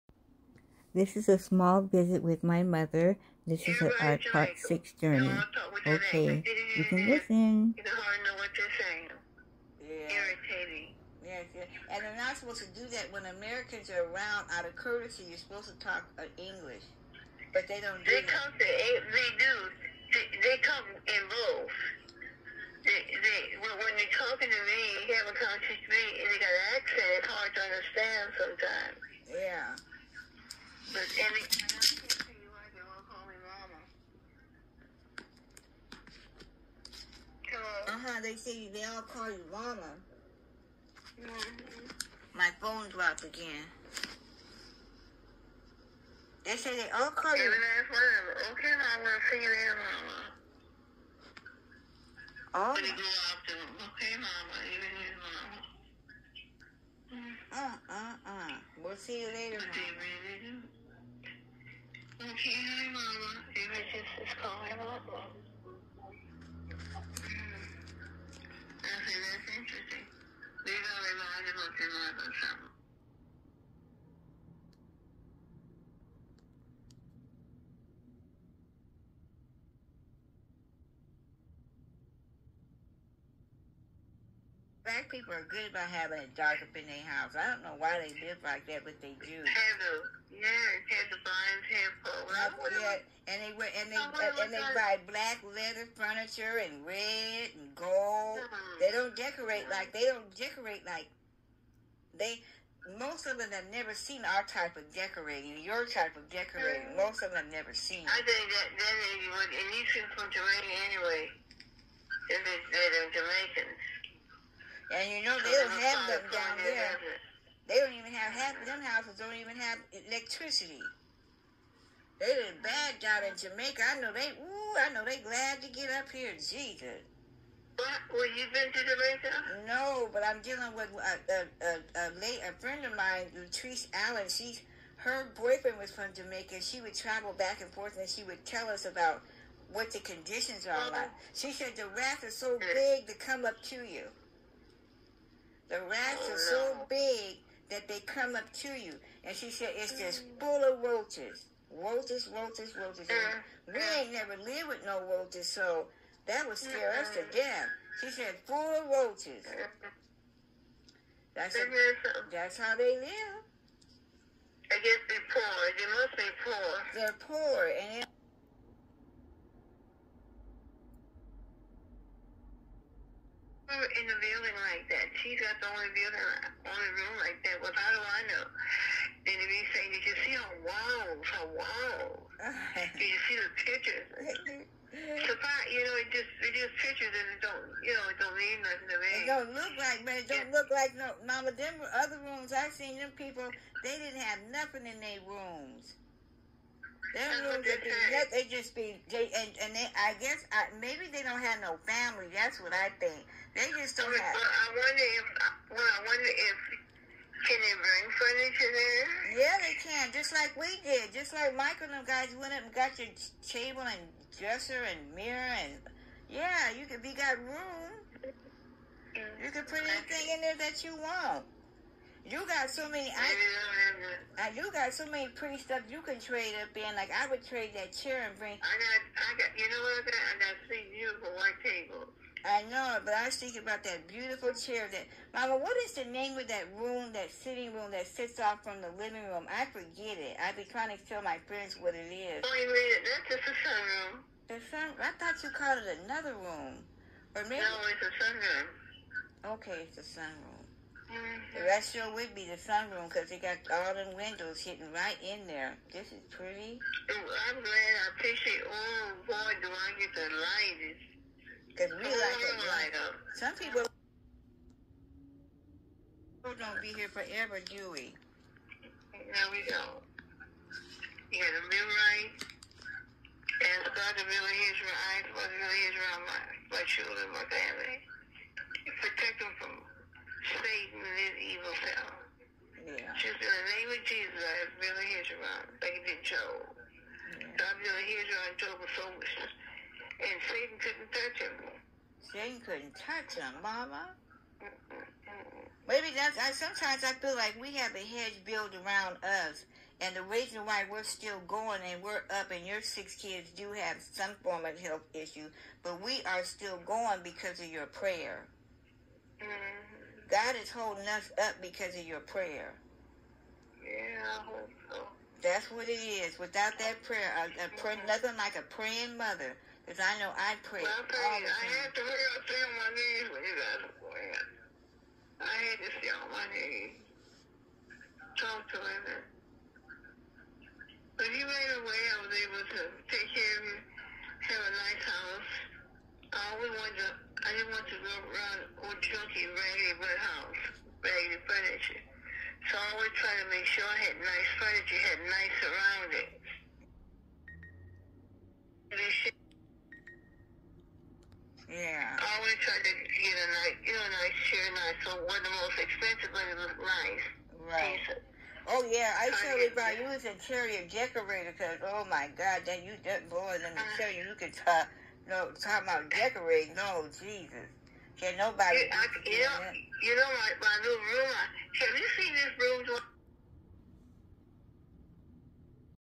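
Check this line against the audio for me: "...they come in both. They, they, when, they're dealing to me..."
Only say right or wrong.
wrong.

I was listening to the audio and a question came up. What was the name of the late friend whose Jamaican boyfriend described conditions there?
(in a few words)
Latrice Allen.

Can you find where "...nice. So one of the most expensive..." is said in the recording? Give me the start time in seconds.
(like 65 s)
354 s.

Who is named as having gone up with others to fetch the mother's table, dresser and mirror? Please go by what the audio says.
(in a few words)
Michael.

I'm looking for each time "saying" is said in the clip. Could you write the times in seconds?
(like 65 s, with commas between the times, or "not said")
8 s, 179 s.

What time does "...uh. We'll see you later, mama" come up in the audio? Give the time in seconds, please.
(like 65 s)
58 s.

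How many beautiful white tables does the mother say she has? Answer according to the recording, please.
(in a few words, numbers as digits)
3.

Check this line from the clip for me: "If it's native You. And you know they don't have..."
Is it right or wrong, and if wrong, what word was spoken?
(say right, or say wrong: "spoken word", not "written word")
wrong: "Jamaicans", not "You".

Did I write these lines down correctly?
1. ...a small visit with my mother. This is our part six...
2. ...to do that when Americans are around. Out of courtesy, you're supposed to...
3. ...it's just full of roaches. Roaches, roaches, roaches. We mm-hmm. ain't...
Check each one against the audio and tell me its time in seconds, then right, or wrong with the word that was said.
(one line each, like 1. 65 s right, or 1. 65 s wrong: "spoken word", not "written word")
1. 1 s right
2. 12 s right
3. 149 s right.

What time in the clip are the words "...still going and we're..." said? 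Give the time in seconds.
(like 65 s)
301 s.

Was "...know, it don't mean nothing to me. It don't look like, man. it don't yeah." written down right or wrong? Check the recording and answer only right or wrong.
right.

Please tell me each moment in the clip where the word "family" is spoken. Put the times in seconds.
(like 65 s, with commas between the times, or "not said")
201 s, 277 s.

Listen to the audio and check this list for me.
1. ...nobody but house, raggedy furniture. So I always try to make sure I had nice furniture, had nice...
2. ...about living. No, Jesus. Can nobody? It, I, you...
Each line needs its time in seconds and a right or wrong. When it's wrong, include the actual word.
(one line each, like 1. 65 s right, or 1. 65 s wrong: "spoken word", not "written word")
1. 339 s wrong: "raggedy", not "nobody"
2. 365 s wrong: "decorating", not "living".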